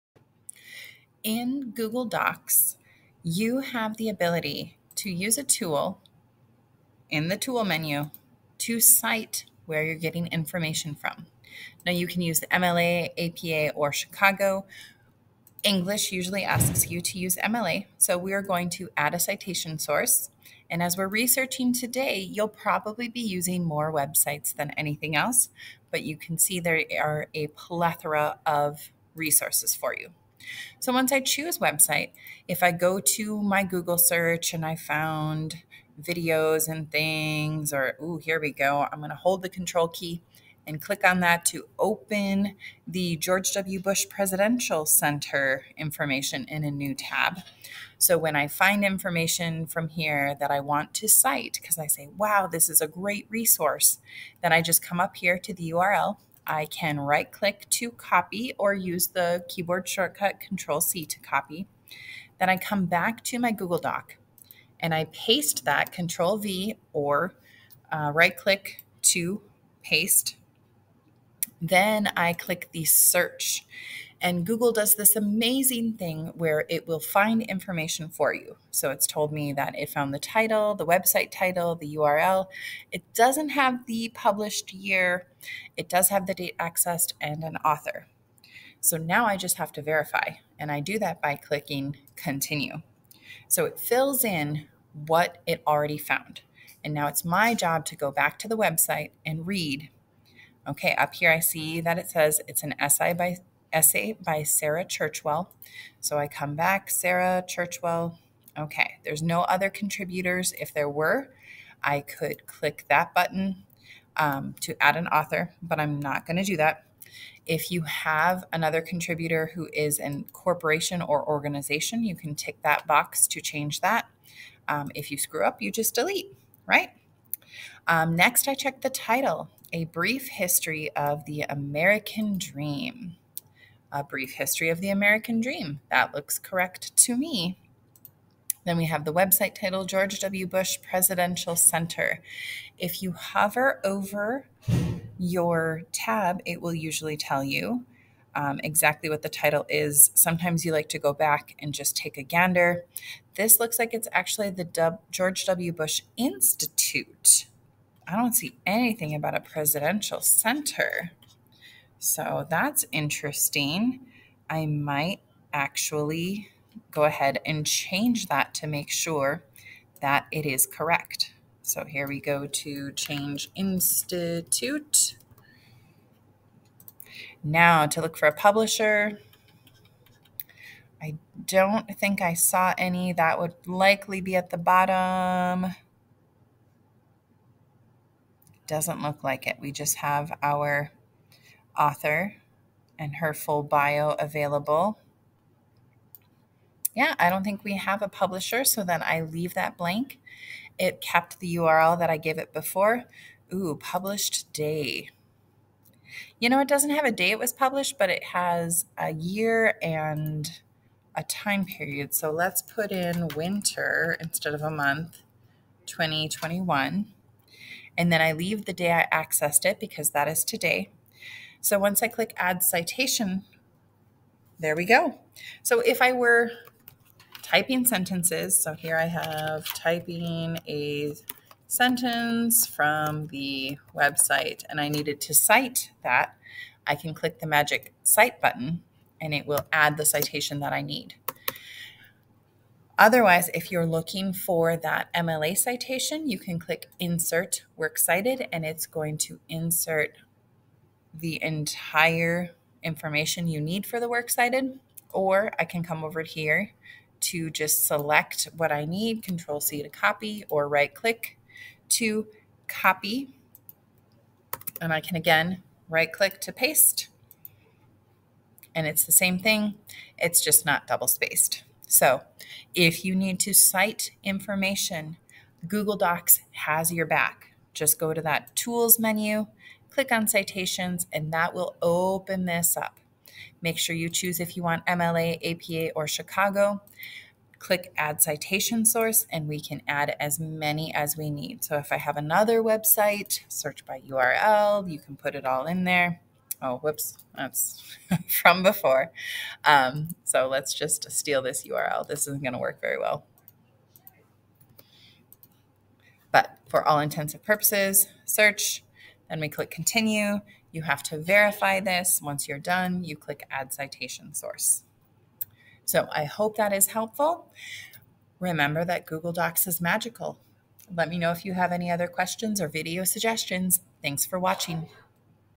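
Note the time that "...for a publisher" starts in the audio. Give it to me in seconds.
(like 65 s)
178 s.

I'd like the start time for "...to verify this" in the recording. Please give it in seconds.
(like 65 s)
311 s.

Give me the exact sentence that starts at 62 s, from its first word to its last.
Then I come back to my Google Doc and I paste that Control V or uh, right click to paste.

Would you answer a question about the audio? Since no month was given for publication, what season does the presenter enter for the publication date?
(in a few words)
Winter.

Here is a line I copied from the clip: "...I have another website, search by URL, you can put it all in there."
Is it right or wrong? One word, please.
right.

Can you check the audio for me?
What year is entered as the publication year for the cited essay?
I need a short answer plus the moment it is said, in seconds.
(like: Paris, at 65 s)
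2021, at 215 s.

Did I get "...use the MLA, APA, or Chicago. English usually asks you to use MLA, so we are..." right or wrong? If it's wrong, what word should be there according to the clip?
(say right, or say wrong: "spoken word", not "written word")
right.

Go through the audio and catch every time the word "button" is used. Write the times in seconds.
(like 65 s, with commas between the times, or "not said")
113 s, 238 s.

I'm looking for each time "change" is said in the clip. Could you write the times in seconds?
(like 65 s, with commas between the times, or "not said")
123 s, 167 s, 172 s.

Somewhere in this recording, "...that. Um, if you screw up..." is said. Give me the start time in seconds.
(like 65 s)
123 s.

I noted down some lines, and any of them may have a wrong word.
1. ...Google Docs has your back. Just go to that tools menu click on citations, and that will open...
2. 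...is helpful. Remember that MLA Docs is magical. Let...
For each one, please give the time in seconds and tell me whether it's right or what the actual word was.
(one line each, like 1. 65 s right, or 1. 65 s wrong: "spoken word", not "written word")
1. 275 s right
2. 316 s wrong: "Google", not "MLA".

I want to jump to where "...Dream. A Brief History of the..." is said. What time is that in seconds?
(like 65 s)
132 s.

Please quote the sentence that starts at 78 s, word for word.
So it's told me that it found the title, the website title, the URL.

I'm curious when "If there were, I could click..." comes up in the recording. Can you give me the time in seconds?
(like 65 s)
110 s.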